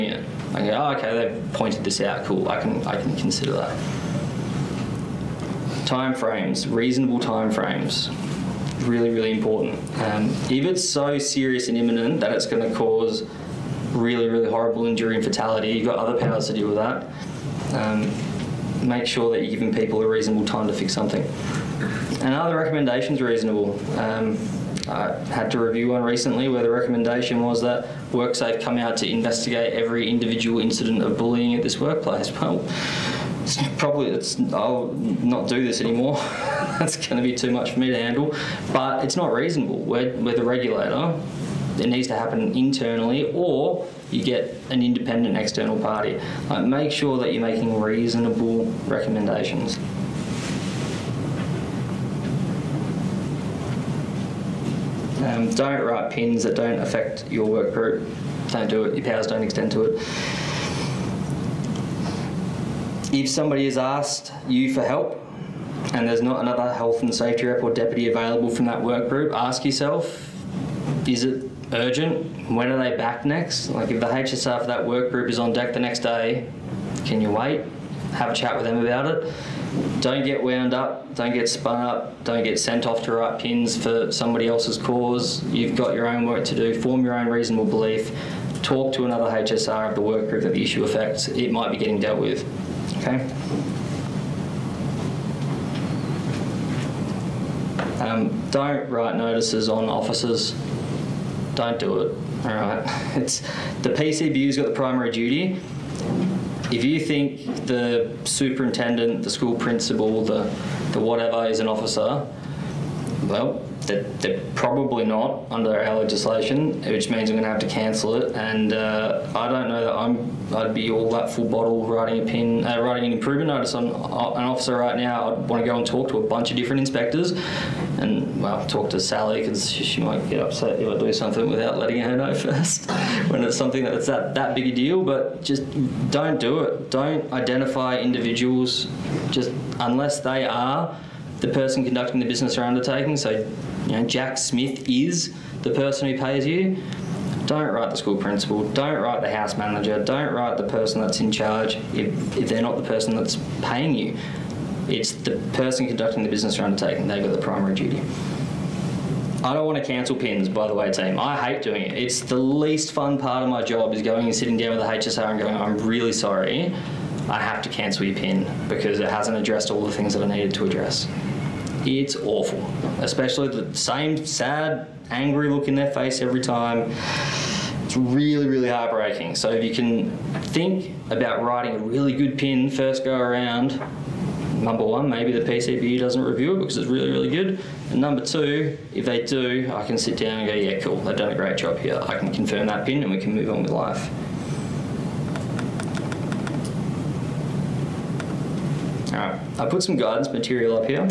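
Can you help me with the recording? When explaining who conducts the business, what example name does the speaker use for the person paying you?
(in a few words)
Jack Smith.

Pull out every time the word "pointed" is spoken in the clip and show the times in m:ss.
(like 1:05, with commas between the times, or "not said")
0:01.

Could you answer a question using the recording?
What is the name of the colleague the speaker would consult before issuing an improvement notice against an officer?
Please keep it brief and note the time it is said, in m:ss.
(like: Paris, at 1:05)
Sally, at 2:08.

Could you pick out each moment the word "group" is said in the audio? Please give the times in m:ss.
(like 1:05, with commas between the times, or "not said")
0:57, 1:09, 1:15, 1:30.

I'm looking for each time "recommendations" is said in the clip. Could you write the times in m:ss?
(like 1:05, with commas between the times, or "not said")
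0:22, 0:26, 0:48.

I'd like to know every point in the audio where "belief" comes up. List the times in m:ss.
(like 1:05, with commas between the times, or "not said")
1:27.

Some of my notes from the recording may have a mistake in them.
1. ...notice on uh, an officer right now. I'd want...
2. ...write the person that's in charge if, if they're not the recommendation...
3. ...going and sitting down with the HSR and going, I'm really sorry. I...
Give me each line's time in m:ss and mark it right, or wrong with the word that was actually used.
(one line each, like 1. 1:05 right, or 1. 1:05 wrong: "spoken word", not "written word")
1. 2:03 right
2. 2:30 wrong: "person", not "recommendation"
3. 2:44 right.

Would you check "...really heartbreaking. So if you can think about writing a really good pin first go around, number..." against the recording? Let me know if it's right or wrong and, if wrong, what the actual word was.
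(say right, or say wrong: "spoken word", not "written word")
right.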